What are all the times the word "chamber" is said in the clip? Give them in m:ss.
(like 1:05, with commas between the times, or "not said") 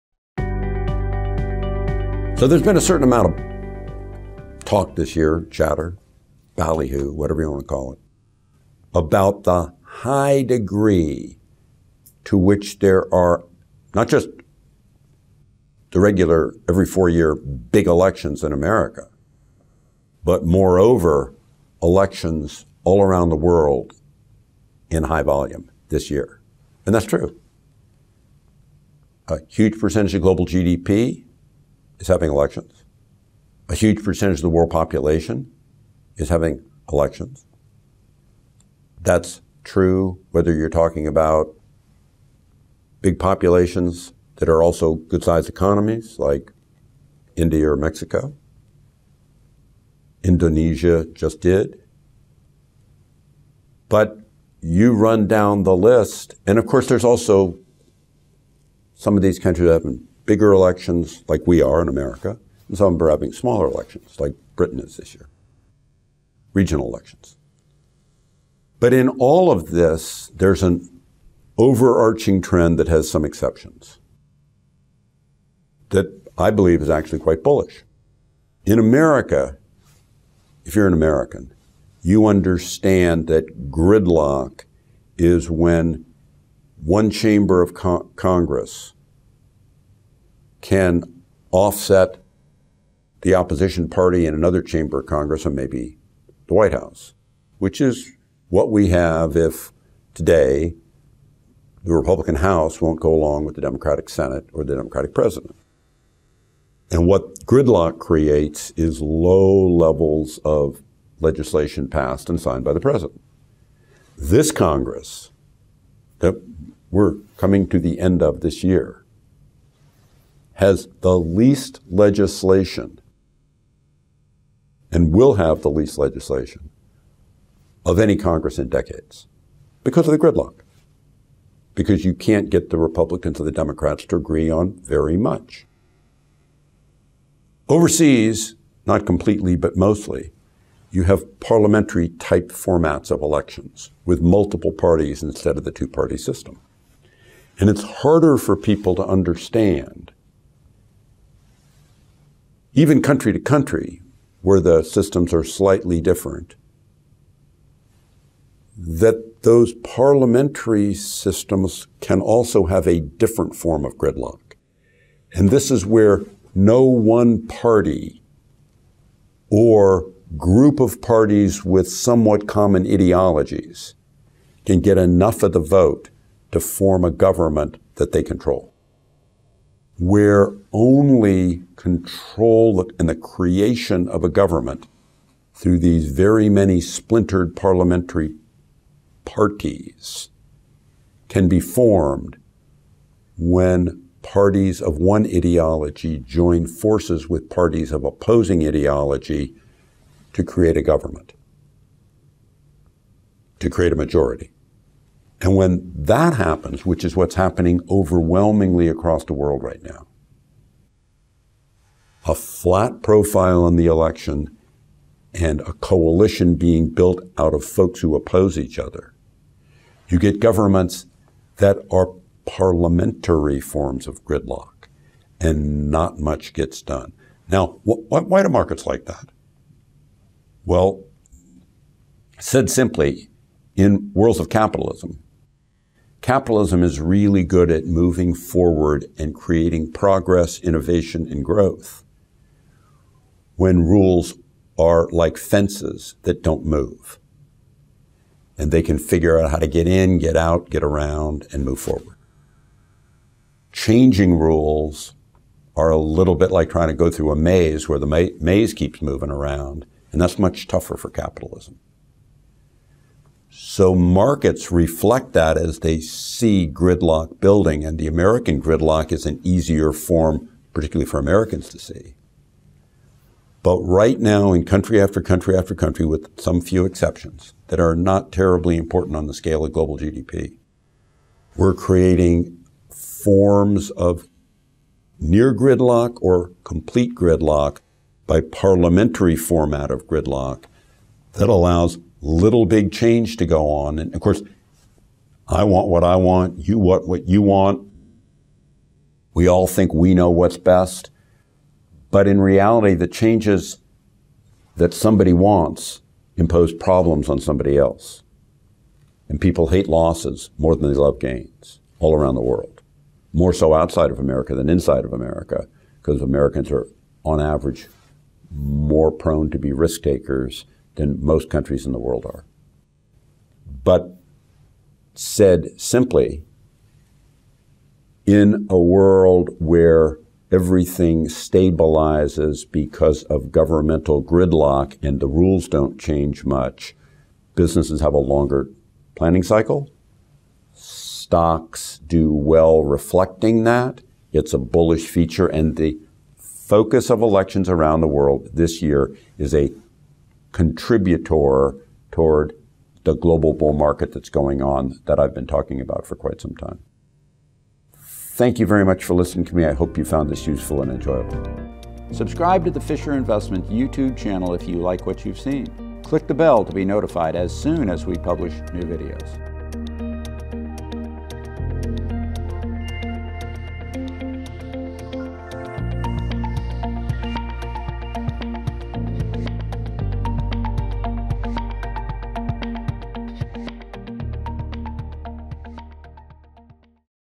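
1:27, 1:34.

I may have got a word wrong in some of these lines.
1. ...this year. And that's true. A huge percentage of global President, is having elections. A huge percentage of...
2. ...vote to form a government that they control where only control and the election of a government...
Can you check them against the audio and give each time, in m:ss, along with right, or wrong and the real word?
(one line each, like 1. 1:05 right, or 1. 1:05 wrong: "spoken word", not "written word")
1. 0:25 wrong: "GDP", not "President"
2. 2:55 wrong: "creation", not "election".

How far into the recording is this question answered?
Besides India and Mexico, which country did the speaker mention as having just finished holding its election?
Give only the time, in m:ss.
0:50.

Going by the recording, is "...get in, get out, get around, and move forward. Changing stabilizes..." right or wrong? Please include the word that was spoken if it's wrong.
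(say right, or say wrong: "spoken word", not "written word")
wrong: "rules", not "stabilizes".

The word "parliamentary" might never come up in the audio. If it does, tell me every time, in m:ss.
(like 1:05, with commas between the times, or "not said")
2:21, 2:39, 3:07, 3:42, 4:48.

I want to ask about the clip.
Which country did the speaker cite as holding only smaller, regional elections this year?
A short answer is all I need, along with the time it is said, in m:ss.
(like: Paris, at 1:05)
Britain, at 1:04.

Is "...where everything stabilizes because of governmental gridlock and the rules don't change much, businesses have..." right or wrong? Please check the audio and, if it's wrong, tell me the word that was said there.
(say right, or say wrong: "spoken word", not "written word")
right.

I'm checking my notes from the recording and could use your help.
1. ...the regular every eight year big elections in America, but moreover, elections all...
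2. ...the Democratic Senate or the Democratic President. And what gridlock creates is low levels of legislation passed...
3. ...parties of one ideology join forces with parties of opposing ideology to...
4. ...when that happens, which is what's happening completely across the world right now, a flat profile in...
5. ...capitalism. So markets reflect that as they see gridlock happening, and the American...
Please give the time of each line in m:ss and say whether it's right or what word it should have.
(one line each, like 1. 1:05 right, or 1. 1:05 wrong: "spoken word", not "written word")
1. 0:15 wrong: "four", not "eight"
2. 1:43 right
3. 3:14 right
4. 3:25 wrong: "overwhelmingly", not "completely"
5. 4:21 wrong: "building", not "happening".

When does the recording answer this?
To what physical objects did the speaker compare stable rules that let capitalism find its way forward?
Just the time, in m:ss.
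4:05.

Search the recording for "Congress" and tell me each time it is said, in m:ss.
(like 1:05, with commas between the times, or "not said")
1:28, 1:35, 1:54, 2:08.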